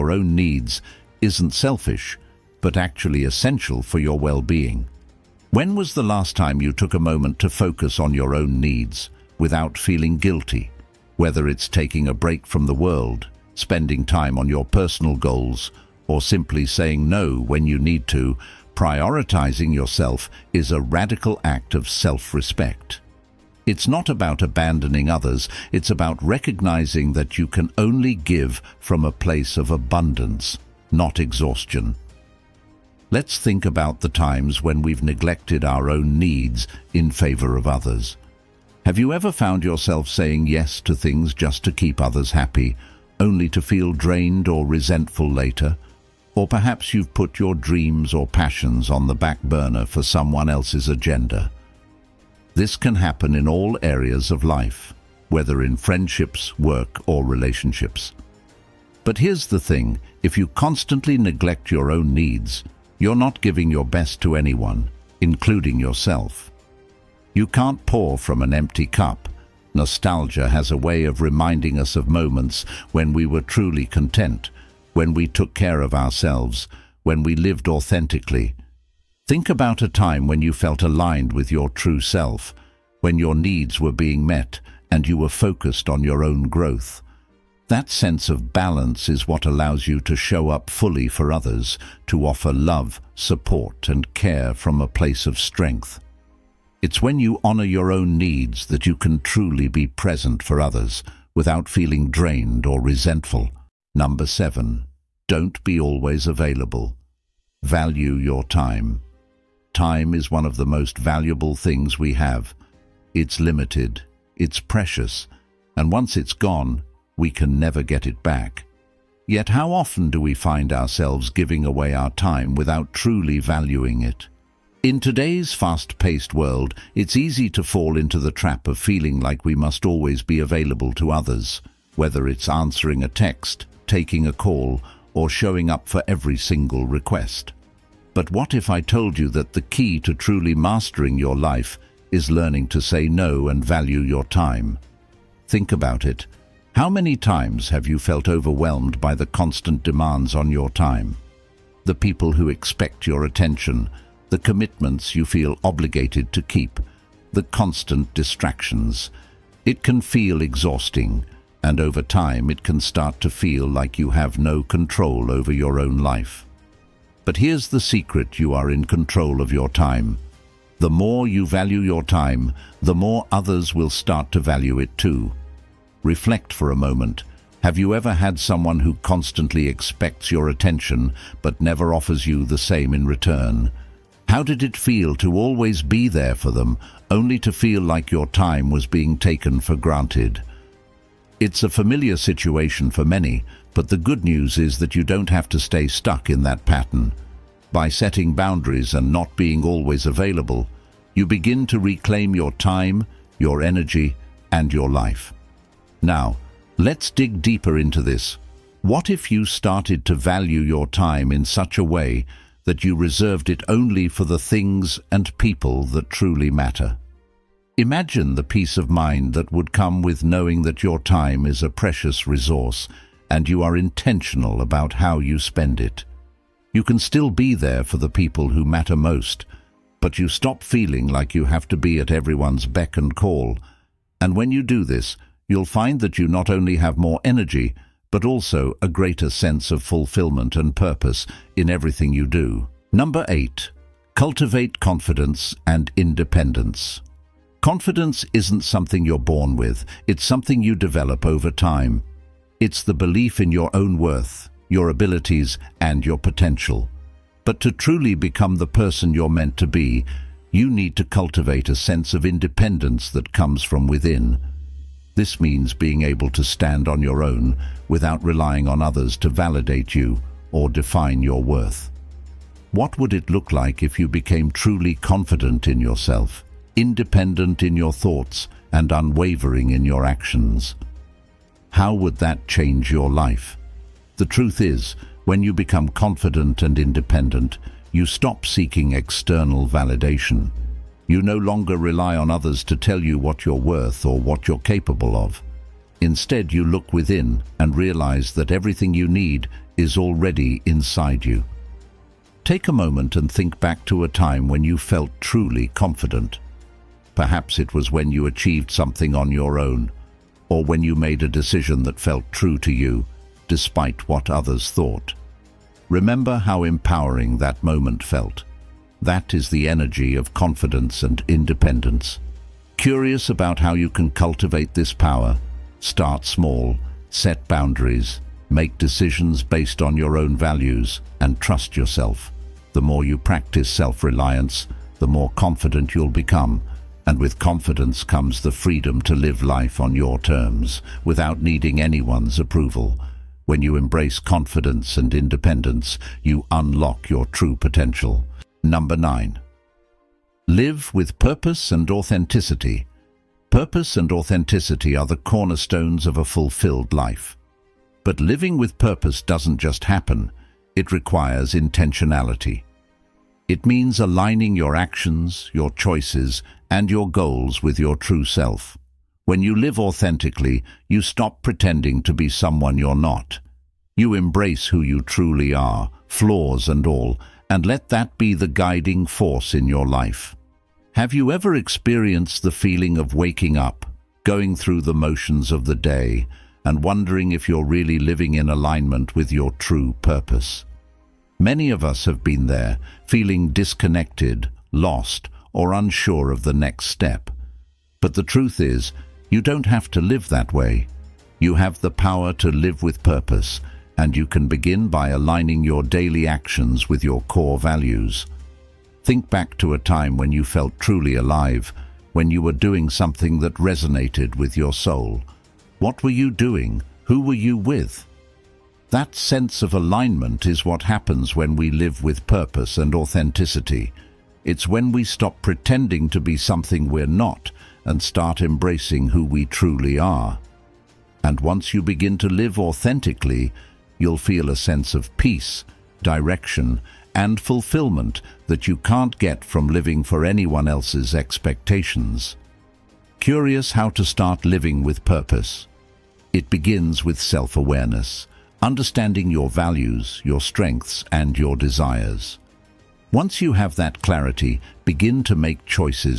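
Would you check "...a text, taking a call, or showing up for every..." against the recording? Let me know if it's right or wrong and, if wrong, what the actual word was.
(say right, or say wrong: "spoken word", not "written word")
right.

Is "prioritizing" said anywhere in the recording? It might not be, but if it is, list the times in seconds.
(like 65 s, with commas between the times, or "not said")
18 s.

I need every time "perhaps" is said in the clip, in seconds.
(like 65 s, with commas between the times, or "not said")
46 s, 307 s.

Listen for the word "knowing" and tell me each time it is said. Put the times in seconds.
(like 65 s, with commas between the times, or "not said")
220 s.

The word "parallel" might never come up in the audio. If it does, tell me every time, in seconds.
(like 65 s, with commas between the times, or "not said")
not said.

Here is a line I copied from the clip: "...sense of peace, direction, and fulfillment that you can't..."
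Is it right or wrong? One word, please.
right.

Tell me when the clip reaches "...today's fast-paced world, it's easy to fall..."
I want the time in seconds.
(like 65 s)
125 s.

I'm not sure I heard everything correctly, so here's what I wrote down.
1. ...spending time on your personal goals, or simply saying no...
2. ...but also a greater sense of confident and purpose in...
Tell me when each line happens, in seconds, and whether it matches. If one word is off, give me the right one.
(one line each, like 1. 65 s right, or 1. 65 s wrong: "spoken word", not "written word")
1. 13 s right
2. 238 s wrong: "fulfillment", not "confident".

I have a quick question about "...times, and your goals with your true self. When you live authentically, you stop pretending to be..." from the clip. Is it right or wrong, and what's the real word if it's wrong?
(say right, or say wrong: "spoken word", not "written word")
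wrong: "choices", not "times".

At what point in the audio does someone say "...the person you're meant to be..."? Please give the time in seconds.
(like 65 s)
258 s.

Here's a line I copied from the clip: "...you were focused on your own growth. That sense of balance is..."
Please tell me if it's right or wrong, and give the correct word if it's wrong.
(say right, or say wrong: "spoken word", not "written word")
right.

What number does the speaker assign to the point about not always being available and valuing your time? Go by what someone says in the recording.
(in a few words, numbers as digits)
7.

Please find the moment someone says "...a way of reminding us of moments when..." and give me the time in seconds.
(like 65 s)
70 s.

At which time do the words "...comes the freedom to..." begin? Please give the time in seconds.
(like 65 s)
338 s.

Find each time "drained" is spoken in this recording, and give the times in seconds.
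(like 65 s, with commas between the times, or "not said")
43 s, 102 s.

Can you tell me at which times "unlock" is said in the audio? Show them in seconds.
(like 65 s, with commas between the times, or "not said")
346 s.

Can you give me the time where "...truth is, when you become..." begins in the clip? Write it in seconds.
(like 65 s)
284 s.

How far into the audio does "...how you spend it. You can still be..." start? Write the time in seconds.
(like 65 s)
224 s.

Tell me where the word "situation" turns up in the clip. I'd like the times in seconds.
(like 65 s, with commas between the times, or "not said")
192 s.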